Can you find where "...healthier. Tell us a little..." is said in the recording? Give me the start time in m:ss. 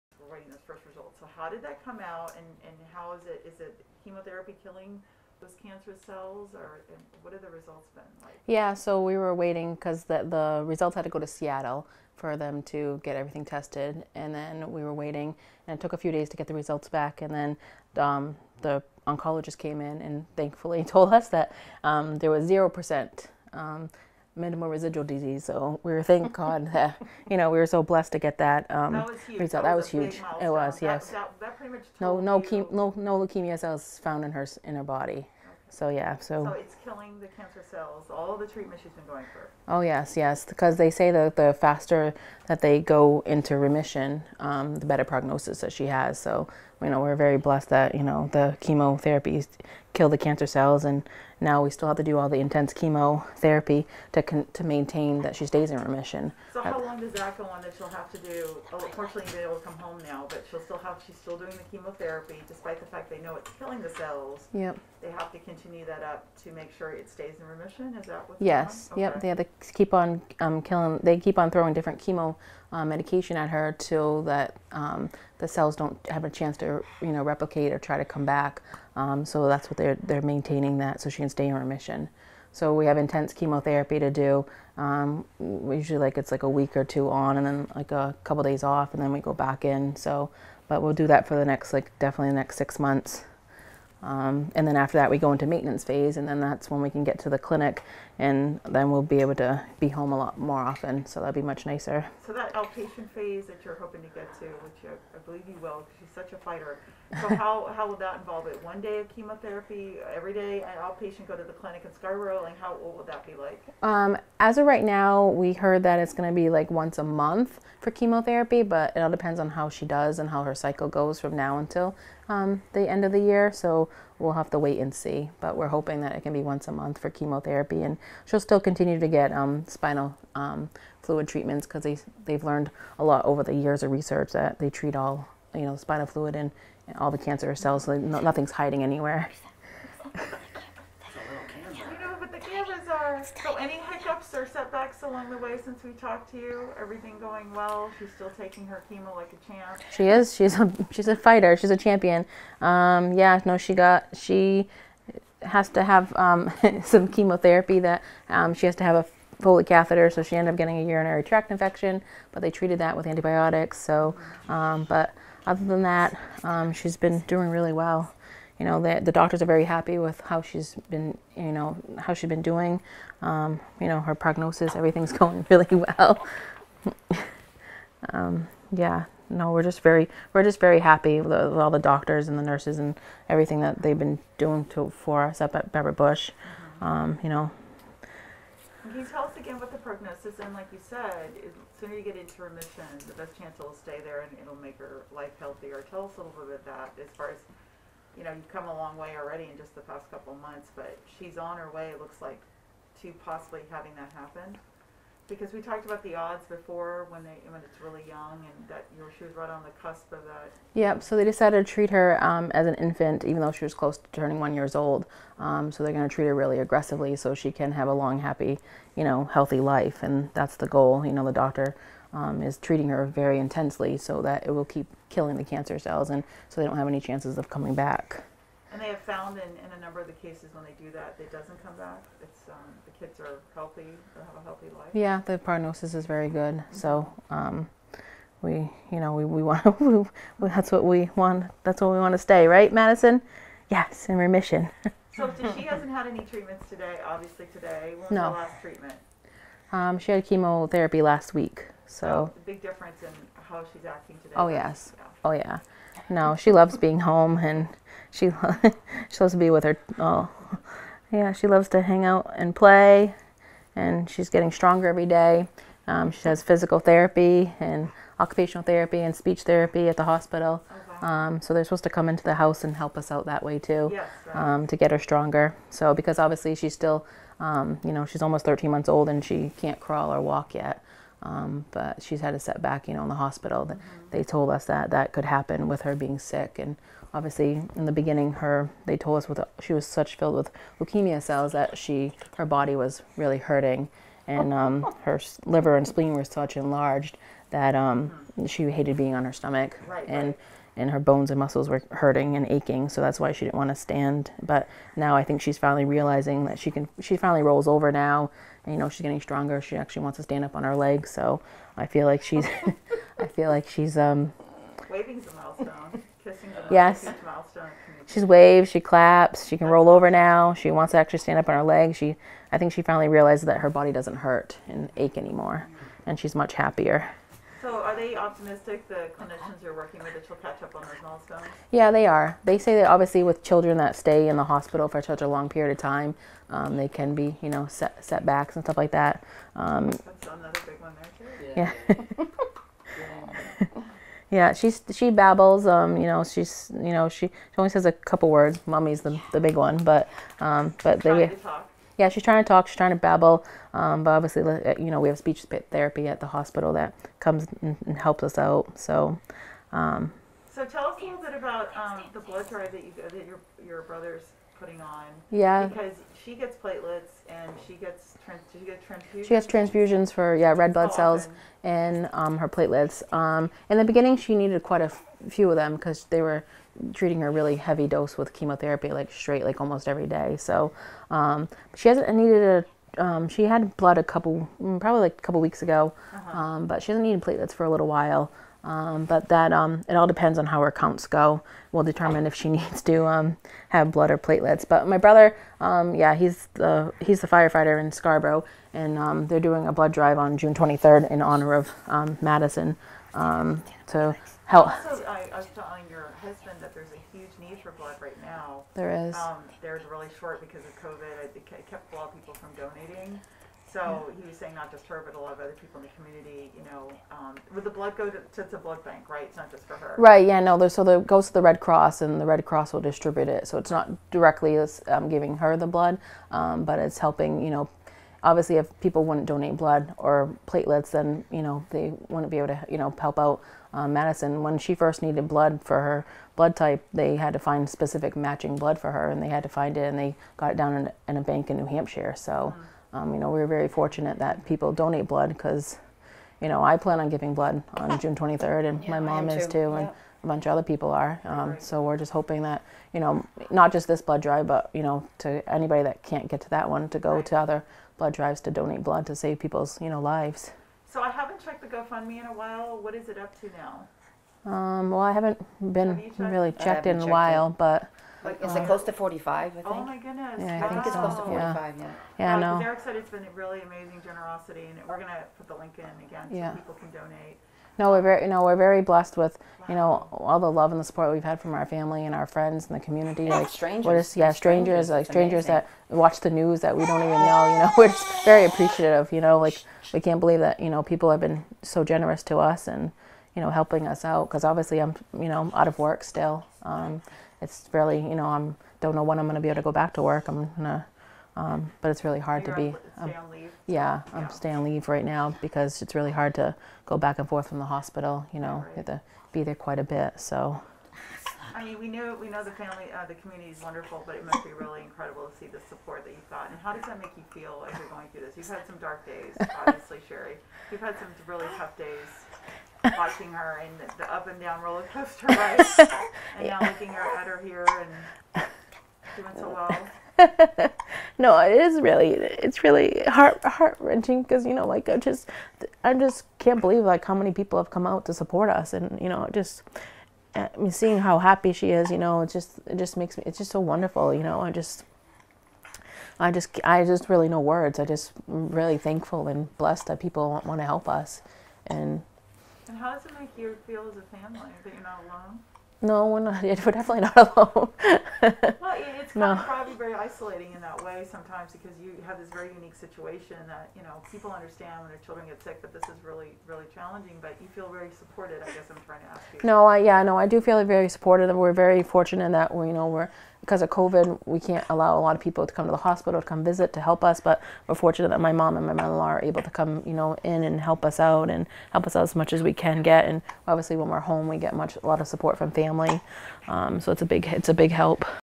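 3:15.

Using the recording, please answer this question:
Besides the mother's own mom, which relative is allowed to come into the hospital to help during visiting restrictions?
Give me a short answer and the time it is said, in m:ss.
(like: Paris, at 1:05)
Mother-in-law, at 9:38.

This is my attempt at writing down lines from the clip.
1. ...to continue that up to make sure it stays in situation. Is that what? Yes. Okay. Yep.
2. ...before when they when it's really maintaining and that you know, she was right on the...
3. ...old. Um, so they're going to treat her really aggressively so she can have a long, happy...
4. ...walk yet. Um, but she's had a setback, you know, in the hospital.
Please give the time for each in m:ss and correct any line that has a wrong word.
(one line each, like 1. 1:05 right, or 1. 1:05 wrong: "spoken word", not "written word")
1. 1:05 wrong: "remission", not "situation"
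2. 3:26 wrong: "young", not "maintaining"
3. 3:34 right
4. 4:40 right.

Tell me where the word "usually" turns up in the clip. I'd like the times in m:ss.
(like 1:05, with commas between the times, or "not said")
1:25.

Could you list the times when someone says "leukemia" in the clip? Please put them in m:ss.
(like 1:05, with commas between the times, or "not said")
0:33, 4:50.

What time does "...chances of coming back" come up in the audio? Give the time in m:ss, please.
3:46.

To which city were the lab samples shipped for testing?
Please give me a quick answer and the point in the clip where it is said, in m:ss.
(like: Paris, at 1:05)
Seattle, at 0:11.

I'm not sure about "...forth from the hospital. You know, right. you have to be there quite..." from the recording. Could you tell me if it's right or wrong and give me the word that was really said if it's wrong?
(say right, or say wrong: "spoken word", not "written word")
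right.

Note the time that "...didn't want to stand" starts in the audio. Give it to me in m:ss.
5:03.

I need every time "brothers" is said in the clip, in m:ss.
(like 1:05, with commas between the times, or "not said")
6:03, 6:34.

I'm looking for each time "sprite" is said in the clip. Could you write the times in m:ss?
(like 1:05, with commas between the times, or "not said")
not said.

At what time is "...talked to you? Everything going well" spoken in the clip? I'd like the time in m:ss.
2:25.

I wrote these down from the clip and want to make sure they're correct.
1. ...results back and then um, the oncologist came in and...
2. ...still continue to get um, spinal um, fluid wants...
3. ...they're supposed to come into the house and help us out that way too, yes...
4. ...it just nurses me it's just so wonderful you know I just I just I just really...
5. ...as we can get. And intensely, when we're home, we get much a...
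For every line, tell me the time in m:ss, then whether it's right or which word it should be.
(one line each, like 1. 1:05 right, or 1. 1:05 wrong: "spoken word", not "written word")
1. 0:16 right
2. 2:08 wrong: "treatments", not "wants"
3. 4:31 right
4. 9:02 wrong: "makes", not "nurses"
5. 9:42 wrong: "obviously", not "intensely".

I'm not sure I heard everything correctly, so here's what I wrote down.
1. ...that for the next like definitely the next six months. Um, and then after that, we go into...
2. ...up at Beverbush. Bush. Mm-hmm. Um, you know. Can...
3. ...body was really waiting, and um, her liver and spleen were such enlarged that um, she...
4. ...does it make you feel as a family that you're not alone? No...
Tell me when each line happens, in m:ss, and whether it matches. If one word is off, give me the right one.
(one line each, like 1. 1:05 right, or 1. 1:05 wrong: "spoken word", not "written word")
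1. 1:31 right
2. 3:05 right
3. 4:52 wrong: "hurting", not "waiting"
4. 9:12 right.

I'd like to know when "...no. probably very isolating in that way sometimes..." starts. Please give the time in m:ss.
9:19.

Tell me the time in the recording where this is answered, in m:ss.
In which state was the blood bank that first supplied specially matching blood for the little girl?
7:21.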